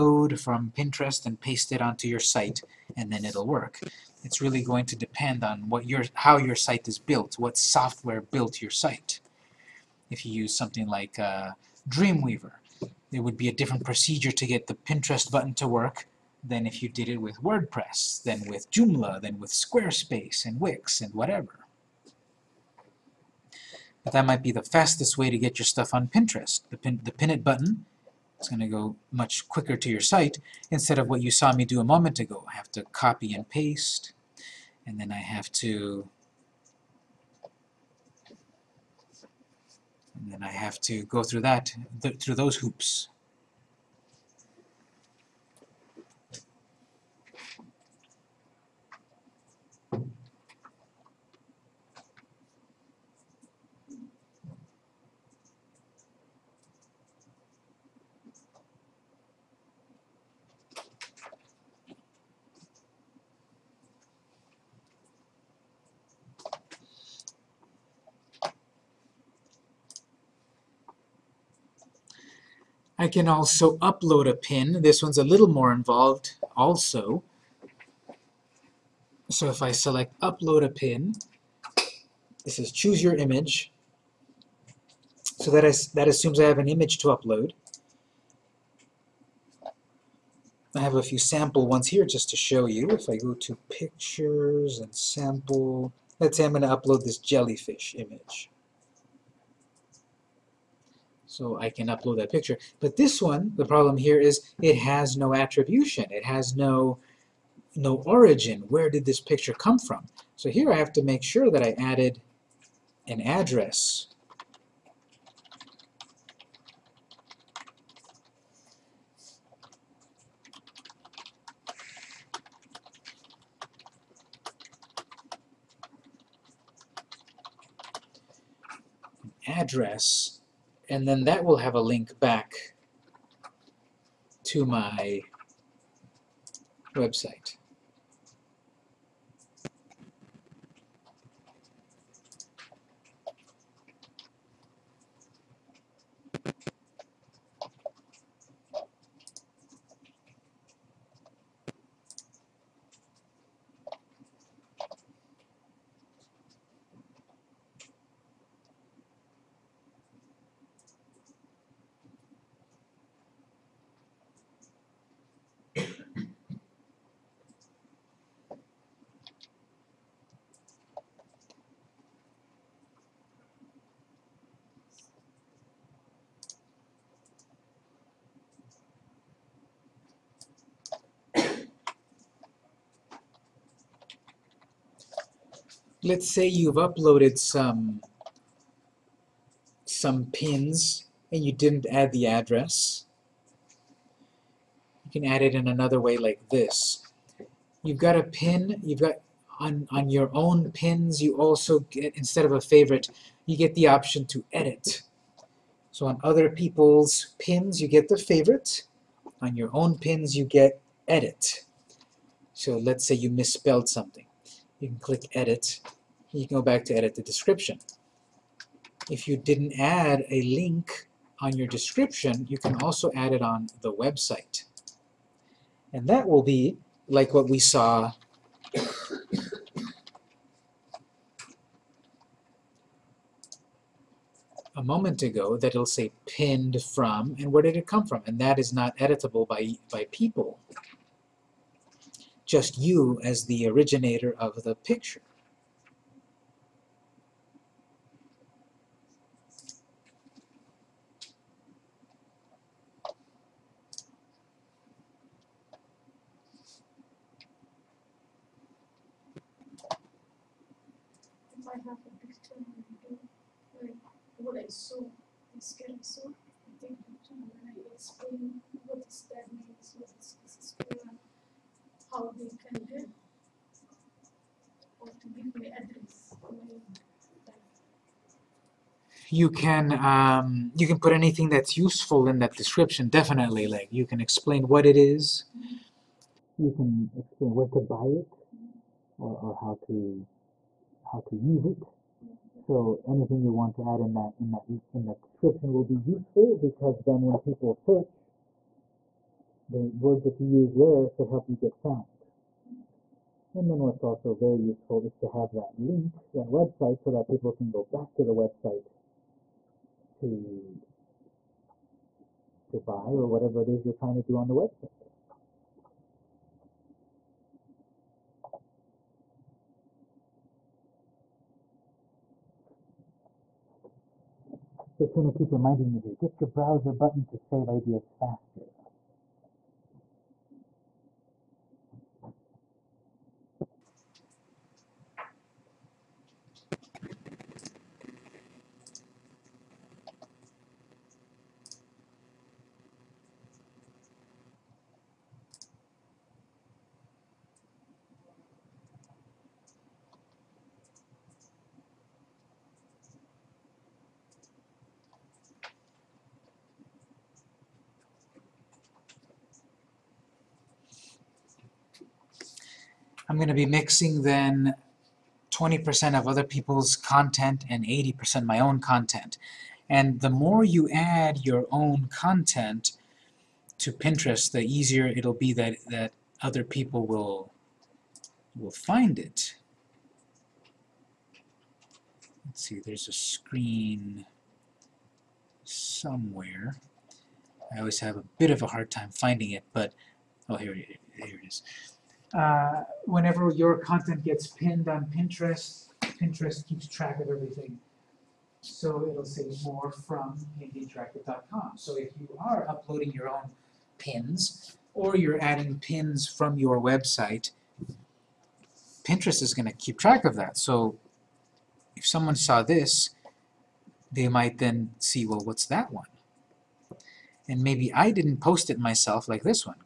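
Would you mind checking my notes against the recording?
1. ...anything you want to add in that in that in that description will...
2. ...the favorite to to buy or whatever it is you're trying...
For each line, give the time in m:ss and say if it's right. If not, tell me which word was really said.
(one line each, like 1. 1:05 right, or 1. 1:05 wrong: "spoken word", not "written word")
1. 4:53 right
2. 5:08 wrong: "website", not "favorite".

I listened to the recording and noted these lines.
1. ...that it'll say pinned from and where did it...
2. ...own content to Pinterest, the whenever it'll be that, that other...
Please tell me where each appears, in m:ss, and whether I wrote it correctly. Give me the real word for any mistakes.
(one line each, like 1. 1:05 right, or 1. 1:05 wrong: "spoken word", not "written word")
1. 3:55 right
2. 6:11 wrong: "easier", not "whenever".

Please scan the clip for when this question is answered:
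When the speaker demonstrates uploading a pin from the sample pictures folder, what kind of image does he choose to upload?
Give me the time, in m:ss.
1:37.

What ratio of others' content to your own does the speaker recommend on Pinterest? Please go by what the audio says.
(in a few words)
20% others, 80% own.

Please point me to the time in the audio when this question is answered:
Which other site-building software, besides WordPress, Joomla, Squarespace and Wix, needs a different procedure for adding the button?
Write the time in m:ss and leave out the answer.
0:11.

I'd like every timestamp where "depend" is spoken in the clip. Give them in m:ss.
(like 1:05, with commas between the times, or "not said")
0:04.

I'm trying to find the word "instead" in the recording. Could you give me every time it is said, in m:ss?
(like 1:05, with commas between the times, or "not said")
0:30, 3:22.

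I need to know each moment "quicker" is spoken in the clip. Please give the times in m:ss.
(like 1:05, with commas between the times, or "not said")
0:29.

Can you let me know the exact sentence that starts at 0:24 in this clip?
But that might be the fastest way to get your stuff on Pinterest.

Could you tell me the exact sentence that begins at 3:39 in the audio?
If you didn't add a link on your description, you can also add it on the website.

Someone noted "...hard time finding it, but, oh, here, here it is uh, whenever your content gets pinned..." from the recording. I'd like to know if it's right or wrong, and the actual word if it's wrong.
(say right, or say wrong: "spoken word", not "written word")
right.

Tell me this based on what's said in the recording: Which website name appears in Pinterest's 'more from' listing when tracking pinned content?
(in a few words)
interactive.com.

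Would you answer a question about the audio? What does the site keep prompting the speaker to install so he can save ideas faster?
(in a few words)
Browser button.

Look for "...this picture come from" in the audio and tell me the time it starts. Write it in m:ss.
1:49.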